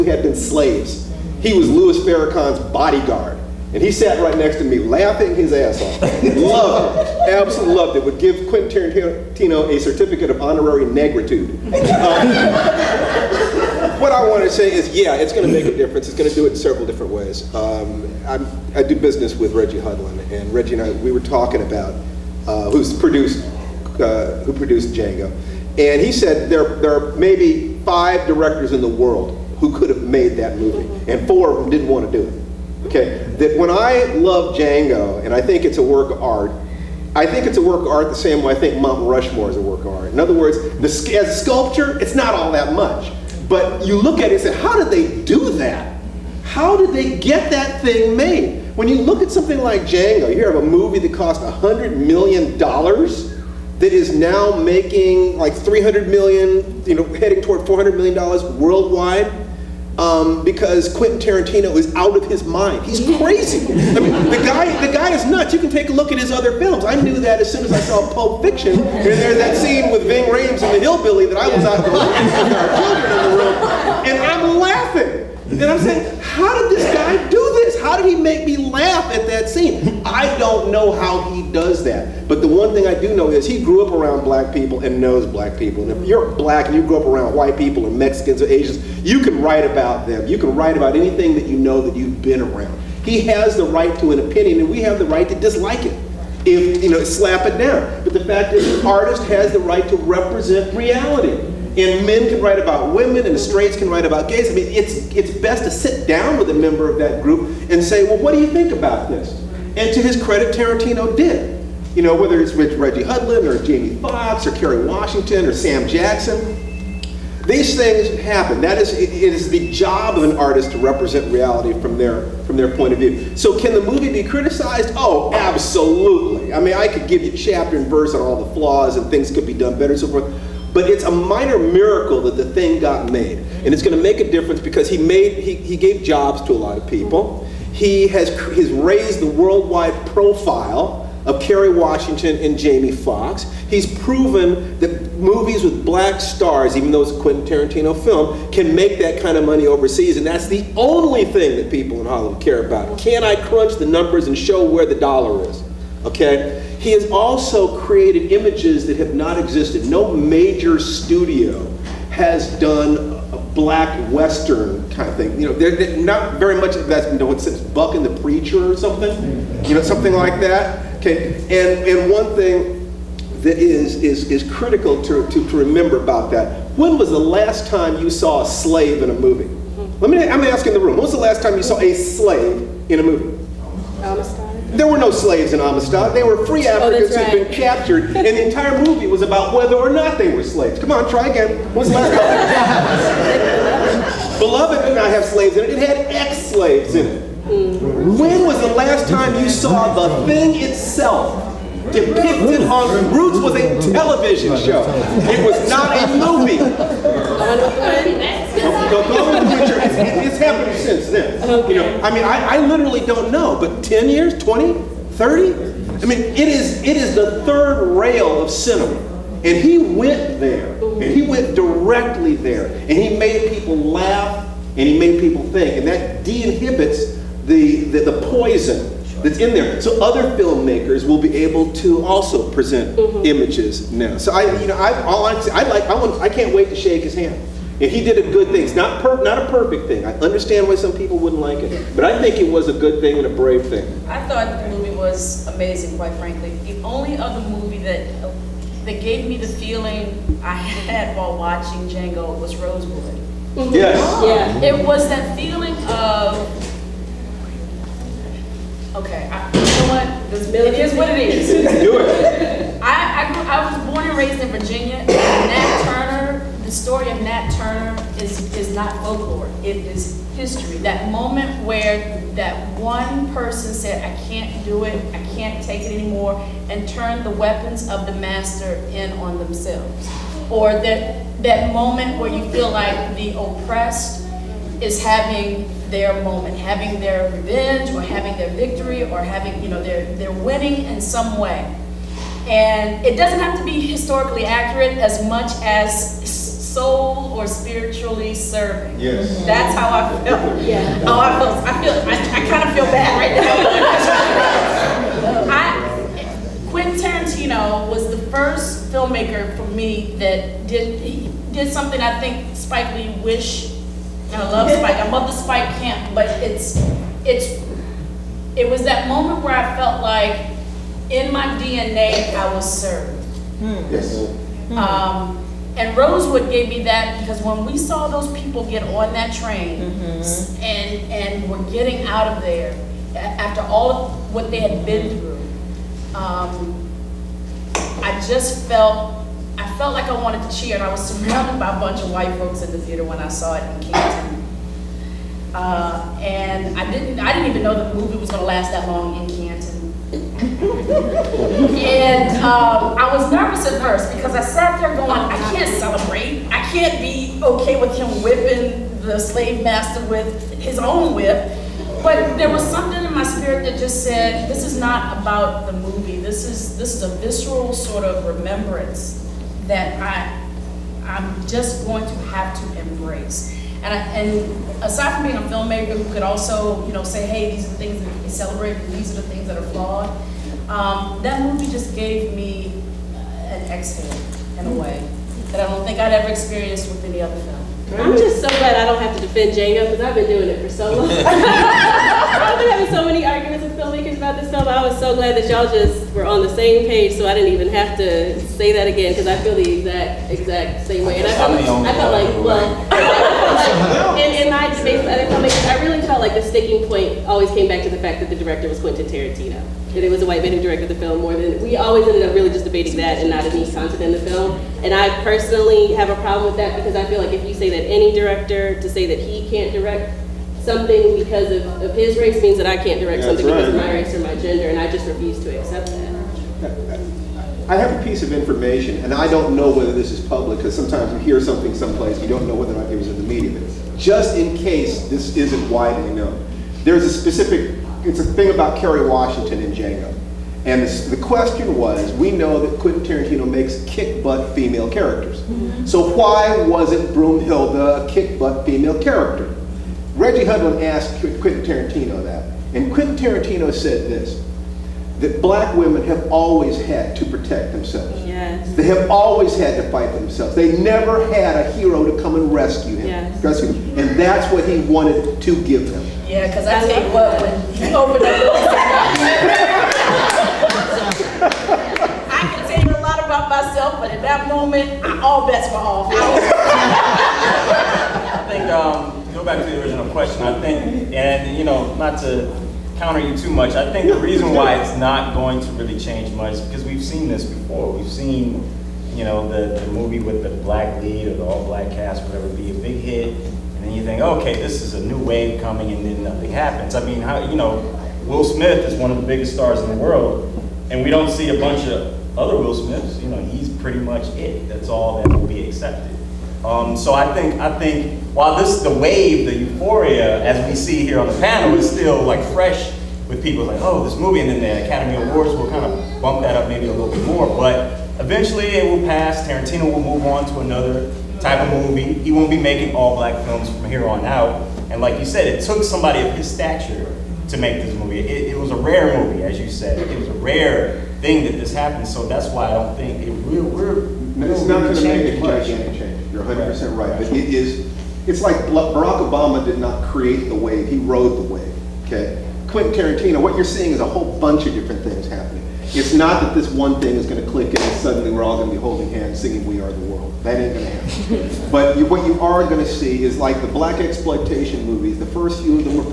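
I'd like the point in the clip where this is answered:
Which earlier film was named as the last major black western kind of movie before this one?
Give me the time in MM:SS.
02:47.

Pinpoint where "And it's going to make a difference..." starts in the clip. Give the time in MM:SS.
02:13.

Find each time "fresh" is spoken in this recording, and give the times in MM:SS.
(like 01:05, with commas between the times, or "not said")
08:32.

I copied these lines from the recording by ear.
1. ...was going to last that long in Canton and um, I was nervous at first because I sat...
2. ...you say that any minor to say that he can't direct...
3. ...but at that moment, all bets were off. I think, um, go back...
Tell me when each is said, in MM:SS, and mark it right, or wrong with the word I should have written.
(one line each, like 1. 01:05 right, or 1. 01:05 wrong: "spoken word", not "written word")
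1. 05:48 right
2. 06:57 wrong: "director", not "minor"
3. 07:53 right.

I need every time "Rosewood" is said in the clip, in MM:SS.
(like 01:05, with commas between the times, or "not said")
04:12, 05:25.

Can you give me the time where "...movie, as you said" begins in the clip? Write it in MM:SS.
08:49.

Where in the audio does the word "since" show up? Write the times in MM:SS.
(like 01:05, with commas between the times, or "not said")
02:47, 03:30.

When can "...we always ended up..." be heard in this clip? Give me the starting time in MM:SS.
06:51.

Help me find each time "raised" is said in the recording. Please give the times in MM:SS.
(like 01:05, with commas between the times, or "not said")
02:18, 04:24.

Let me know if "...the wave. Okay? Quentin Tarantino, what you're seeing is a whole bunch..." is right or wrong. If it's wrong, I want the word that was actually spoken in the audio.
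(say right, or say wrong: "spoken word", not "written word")
right.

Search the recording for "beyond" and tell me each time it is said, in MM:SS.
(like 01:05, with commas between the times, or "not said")
not said.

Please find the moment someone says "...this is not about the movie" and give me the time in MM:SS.
06:04.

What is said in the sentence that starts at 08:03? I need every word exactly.
I think the reason why it's not going to really change much because we've seen this before.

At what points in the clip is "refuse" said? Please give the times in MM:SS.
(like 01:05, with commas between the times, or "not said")
07:05.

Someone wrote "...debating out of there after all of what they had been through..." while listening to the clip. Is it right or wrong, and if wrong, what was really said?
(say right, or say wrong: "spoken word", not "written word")
wrong: "getting", not "debating".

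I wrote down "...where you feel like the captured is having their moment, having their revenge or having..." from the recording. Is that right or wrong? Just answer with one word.
wrong.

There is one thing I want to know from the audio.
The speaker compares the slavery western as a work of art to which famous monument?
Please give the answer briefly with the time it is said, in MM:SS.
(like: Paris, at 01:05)
Mount Rushmore, at 00:38.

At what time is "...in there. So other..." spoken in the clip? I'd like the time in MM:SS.
03:49.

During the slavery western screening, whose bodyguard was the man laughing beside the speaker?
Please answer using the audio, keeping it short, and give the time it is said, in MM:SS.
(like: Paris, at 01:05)
Louis Farrakhan, at 00:01.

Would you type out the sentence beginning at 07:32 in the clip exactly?
And Quentin Tarantino said this, that black women have always had to protect themselves.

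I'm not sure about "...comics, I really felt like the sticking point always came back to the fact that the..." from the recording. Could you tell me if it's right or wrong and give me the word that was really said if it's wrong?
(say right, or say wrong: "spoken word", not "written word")
right.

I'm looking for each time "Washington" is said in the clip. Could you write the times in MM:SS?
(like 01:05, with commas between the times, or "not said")
01:54, 02:21, 07:19.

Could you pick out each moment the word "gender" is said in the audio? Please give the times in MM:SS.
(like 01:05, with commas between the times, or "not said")
07:04.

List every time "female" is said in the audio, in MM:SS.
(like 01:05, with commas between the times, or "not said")
07:24, 07:28.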